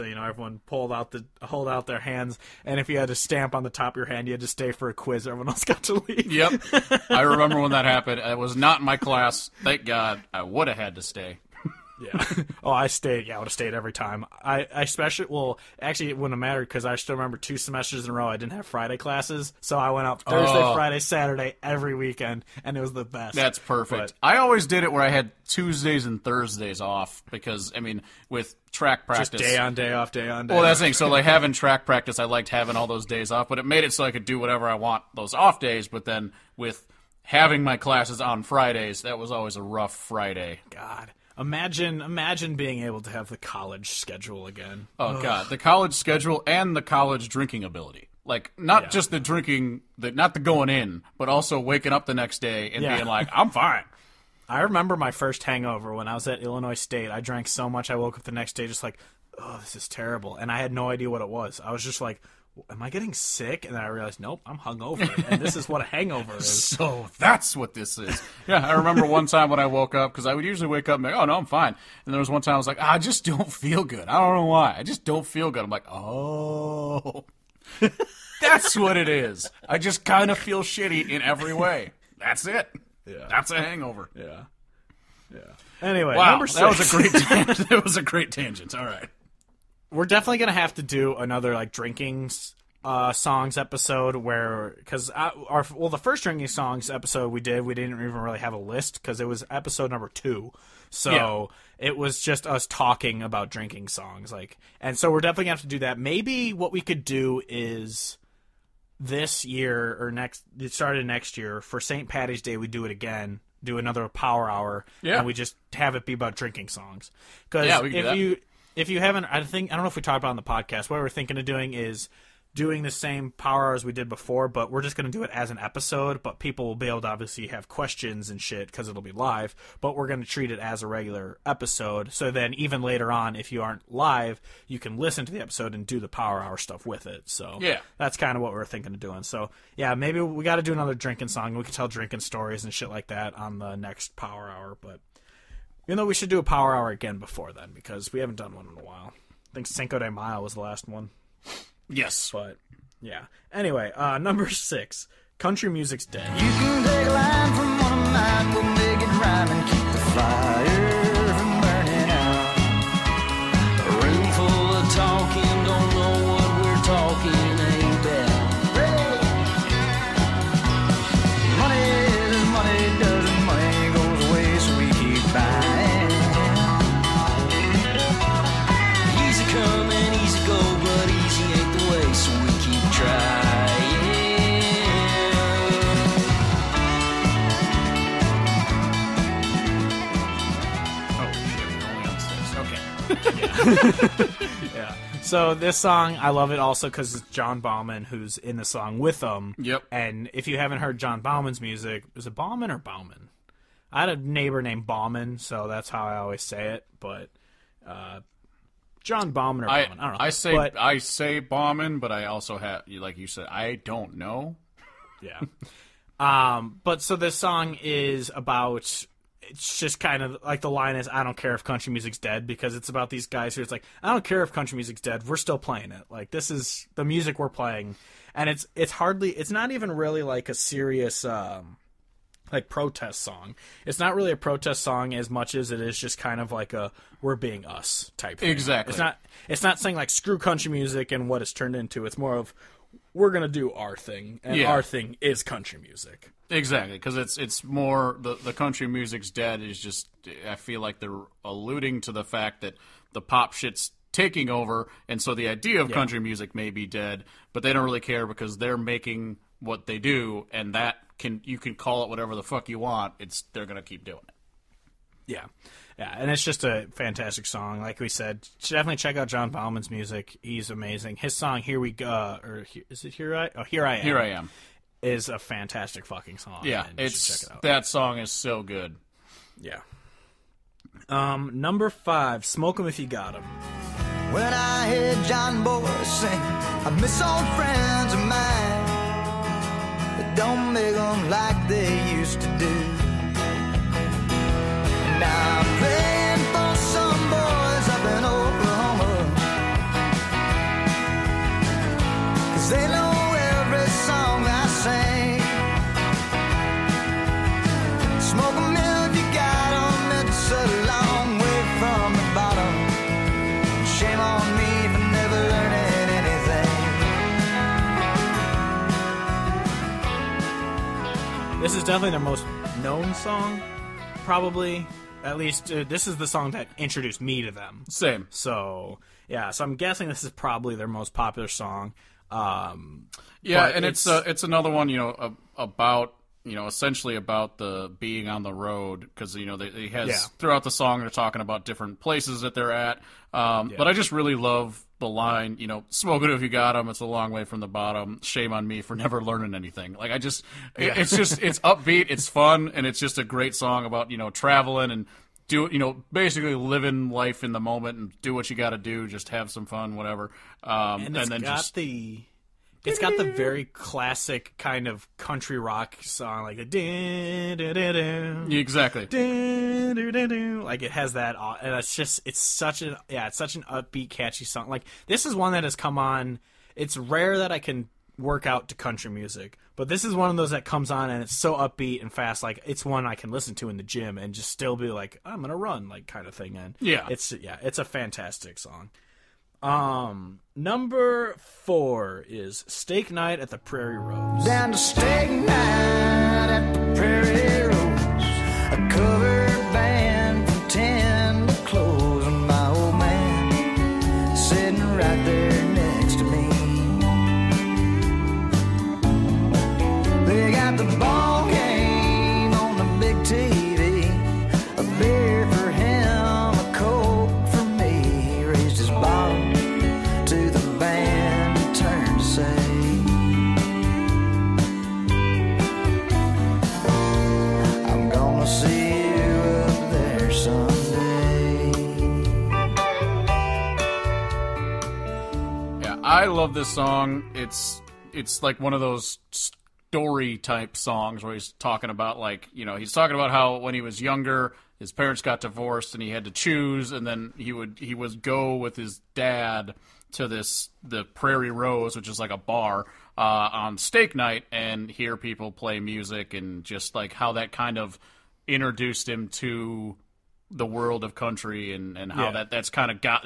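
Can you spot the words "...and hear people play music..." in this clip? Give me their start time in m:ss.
7:34.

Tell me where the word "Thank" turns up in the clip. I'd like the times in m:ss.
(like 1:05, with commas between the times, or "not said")
0:09.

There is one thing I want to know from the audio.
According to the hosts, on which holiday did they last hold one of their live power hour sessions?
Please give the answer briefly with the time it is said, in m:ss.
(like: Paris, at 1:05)
Cinco de Mayo, at 2:29.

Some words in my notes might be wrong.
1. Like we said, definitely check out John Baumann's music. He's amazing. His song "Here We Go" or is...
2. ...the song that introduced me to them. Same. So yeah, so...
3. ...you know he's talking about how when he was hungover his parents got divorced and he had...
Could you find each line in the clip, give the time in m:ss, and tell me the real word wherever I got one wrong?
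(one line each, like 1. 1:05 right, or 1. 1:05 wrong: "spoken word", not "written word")
1. 4:27 right
2. 5:26 right
3. 7:22 wrong: "younger", not "hungover".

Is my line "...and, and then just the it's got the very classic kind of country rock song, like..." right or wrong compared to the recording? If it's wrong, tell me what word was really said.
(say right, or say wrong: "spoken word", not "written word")
right.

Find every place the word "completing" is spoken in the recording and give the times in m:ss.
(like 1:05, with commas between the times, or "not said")
not said.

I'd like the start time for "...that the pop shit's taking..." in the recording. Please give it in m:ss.
4:12.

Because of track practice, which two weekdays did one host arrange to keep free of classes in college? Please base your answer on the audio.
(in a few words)
Tuesdays and Thursdays.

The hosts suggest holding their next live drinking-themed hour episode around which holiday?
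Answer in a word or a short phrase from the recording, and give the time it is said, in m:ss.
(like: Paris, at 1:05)
St. Patty's Day, at 1:51.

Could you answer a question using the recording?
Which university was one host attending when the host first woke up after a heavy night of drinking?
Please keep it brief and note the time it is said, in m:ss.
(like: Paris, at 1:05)
Illinois State, at 0:56.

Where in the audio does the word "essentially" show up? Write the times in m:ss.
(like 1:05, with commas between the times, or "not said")
5:36.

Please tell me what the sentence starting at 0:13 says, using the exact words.
Yeah, I would have stayed every time.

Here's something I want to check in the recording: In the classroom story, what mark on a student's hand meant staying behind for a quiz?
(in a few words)
stamp.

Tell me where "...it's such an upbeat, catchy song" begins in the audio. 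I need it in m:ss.
6:13.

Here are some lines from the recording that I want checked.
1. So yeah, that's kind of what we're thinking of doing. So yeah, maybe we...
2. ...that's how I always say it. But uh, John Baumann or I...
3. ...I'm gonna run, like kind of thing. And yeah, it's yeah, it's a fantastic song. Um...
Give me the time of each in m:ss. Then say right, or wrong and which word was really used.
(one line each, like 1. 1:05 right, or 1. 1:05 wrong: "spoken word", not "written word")
1. 2:17 right
2. 3:25 right
3. 6:25 right.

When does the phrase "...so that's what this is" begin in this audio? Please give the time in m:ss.
1:06.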